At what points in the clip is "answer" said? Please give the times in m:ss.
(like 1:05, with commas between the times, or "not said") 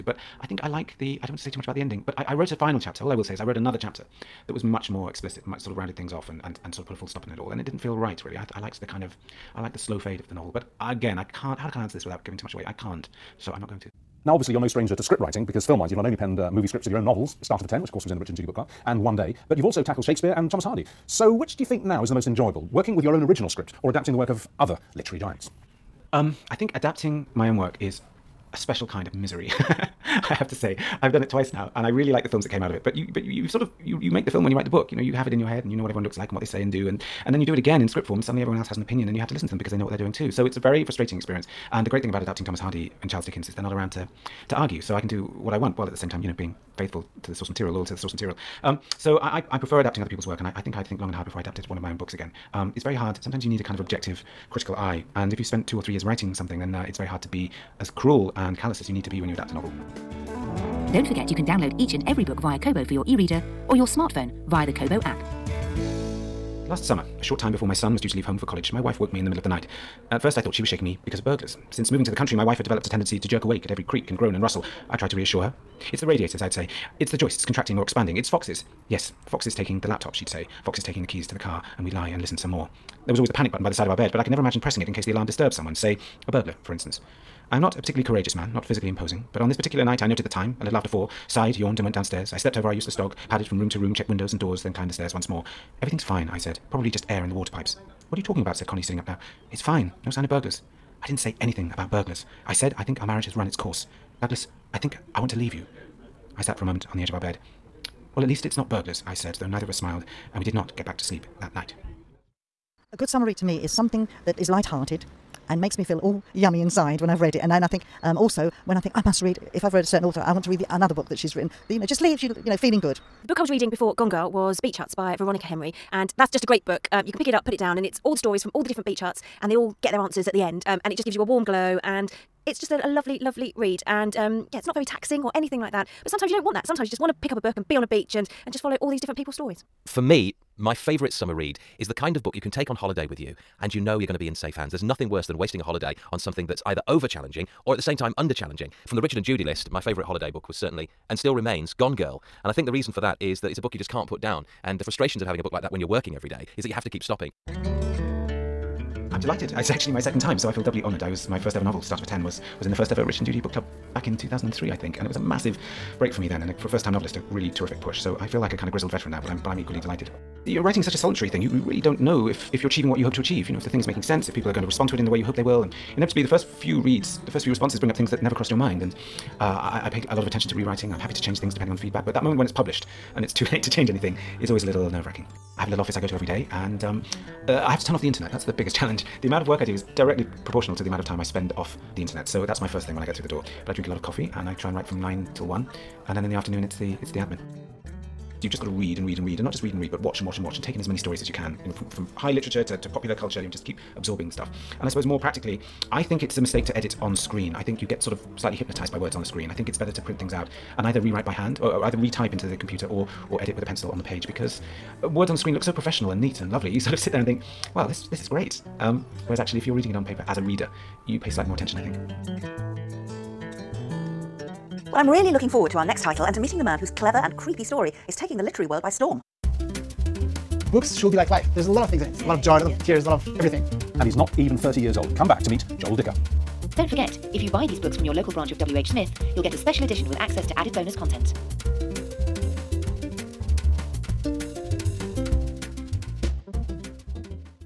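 0:11, 2:09.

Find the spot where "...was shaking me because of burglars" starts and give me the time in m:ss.
1:10.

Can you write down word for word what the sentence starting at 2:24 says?
There's nothing worse than wasting a holiday on something that's either over challenging or at the same time under challenging.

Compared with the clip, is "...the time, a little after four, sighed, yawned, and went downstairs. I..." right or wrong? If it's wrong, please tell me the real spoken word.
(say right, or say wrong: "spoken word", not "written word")
right.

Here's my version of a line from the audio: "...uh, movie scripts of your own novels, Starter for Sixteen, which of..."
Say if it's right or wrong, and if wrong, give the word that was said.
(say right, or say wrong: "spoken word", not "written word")
wrong: "Ten", not "Sixteen".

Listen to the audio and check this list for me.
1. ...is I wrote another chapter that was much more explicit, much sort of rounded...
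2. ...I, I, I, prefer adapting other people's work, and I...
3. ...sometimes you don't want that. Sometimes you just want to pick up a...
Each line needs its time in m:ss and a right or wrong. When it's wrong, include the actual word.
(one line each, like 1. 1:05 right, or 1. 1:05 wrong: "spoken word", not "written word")
1. 0:03 right
2. 0:49 right
3. 2:16 right.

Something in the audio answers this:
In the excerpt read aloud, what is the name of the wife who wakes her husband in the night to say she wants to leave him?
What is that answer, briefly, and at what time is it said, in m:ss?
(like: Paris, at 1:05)
Connie, at 1:38.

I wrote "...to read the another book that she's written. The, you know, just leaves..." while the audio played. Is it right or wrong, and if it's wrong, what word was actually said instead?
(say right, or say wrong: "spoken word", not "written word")
right.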